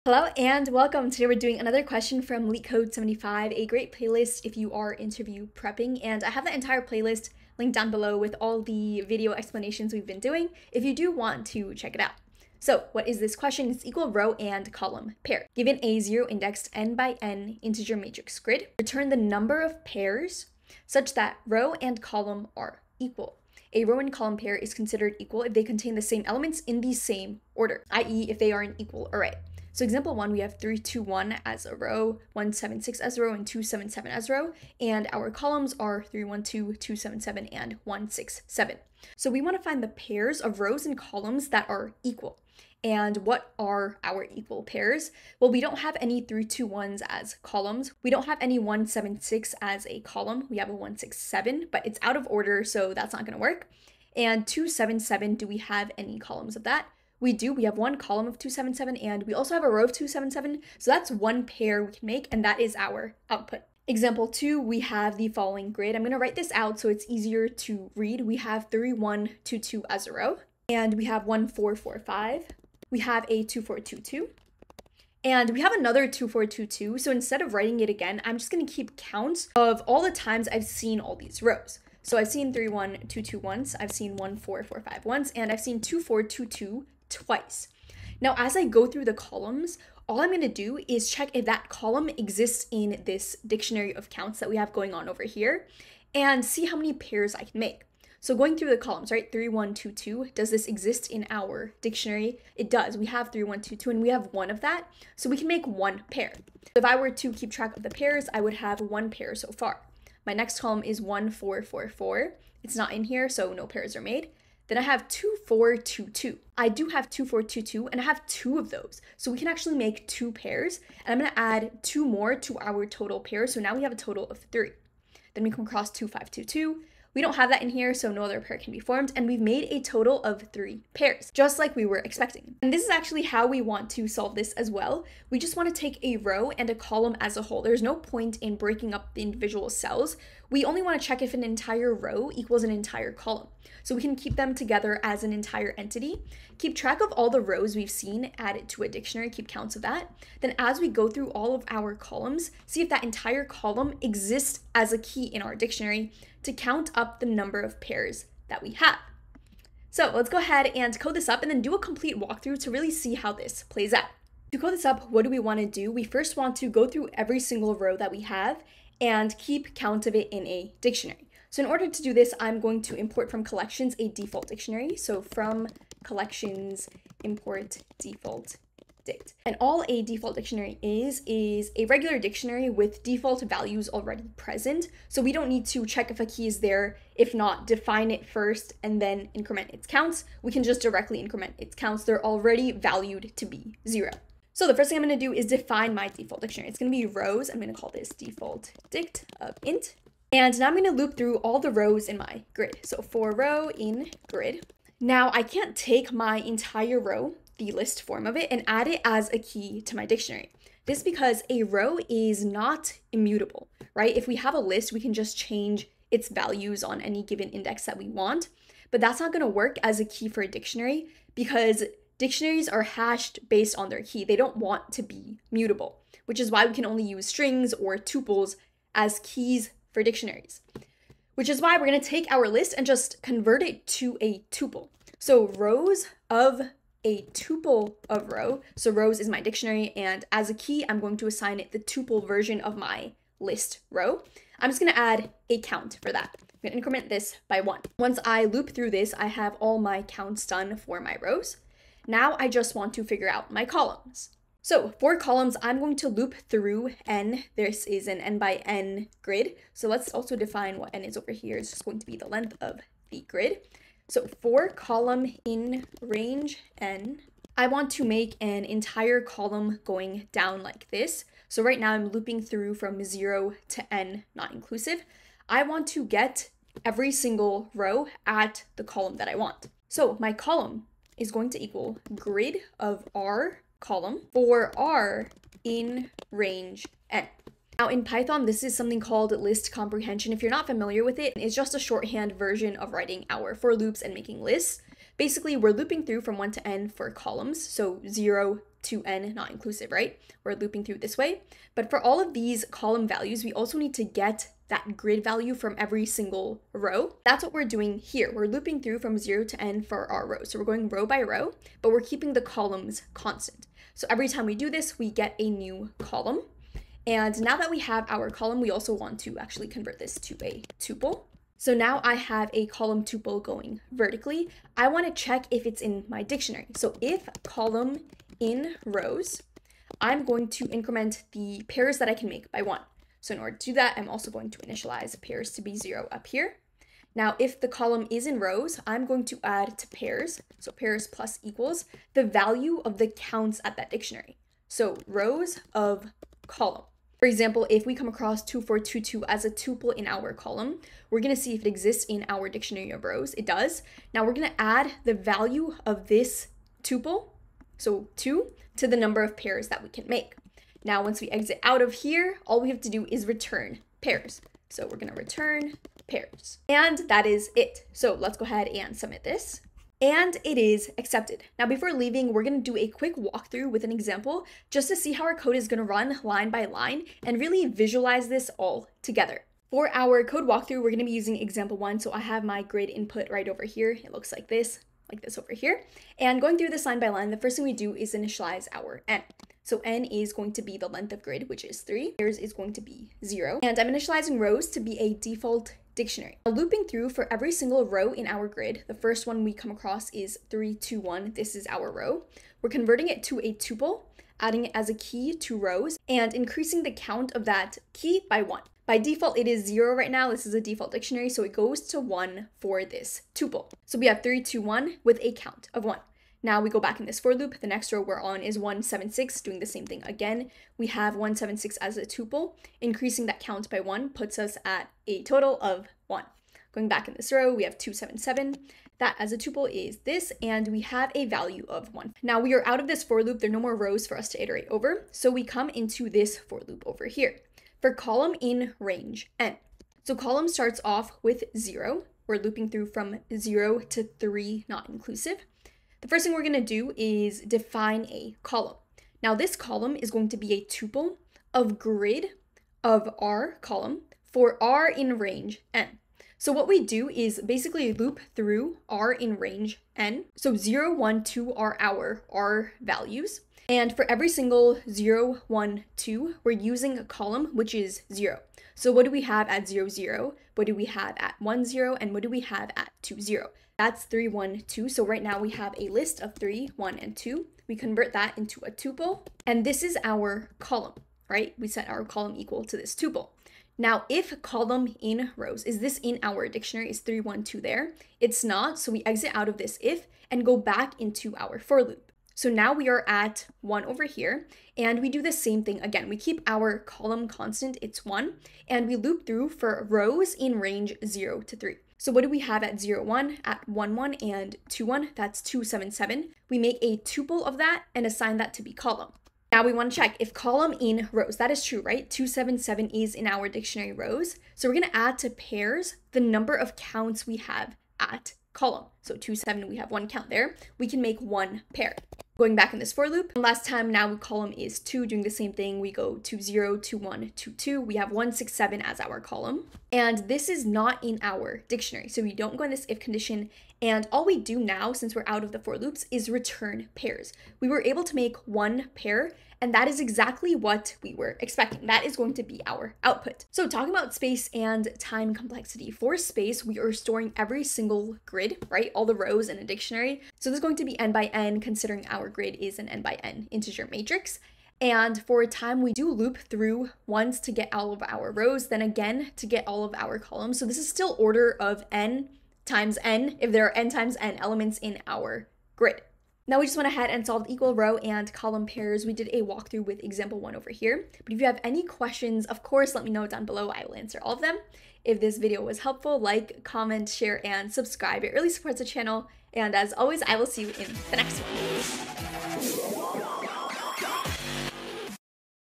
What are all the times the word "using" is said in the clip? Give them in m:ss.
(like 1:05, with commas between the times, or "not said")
6:21, 7:46.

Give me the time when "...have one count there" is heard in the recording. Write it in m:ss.
8:39.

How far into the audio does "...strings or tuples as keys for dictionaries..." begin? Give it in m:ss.
3:47.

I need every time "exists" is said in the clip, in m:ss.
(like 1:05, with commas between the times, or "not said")
1:32, 1:40, 2:34, 5:51.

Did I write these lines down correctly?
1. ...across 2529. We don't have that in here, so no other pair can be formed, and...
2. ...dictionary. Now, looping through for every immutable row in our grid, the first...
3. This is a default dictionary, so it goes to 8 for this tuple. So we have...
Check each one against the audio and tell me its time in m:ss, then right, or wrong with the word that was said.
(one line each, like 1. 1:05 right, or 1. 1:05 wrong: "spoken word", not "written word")
1. 2:05 wrong: "2522", not "2529"
2. 6:35 wrong: "single", not "immutable"
3. 6:50 wrong: "1", not "8".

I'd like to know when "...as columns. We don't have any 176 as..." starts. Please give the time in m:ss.
0:47.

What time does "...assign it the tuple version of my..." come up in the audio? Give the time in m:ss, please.
4:01.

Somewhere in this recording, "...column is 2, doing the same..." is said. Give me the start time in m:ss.
8:44.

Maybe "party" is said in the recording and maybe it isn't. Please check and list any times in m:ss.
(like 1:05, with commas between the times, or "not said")
not said.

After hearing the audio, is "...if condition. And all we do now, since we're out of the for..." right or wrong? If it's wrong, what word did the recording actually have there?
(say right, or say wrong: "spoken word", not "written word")
right.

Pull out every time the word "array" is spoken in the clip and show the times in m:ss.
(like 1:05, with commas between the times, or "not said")
0:29.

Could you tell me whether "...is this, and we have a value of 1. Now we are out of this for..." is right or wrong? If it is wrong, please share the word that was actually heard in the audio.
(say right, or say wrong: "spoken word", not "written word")
right.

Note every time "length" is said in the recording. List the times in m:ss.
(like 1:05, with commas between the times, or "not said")
4:22, 6:30.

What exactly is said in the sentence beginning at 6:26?
And going through this line by line, the first thing we do is initialize our n.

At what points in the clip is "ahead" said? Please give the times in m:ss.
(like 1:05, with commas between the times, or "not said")
2:40, 6:08, 9:26.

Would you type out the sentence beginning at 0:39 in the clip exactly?
So we want to find the pairs of rows and columns that are equal.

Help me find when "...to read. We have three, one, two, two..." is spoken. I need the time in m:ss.
1:07.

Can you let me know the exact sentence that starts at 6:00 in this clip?
Now, once we exit out of here, all we have to do is return pairs.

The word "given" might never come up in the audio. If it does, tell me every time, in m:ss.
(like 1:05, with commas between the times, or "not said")
0:15, 3:37.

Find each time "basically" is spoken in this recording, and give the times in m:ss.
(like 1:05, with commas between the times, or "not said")
4:55, 7:37.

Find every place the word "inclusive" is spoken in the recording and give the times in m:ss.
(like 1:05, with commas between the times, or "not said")
4:34, 4:59, 7:24.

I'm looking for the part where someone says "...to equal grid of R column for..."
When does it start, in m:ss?
4:41.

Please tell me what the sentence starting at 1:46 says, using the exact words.
If I were to keep track of the pairs, I would have one pair so far.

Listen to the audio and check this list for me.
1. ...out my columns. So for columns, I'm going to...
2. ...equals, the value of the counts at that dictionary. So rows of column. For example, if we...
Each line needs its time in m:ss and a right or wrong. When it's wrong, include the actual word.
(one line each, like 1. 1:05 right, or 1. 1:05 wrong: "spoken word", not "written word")
1. 4:13 right
2. 5:41 right.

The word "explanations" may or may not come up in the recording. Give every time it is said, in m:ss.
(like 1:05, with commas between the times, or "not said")
0:09.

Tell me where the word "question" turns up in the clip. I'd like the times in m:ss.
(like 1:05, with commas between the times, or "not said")
0:01, 0:13, 9:31.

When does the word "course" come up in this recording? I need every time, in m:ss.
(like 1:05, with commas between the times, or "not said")
9:32.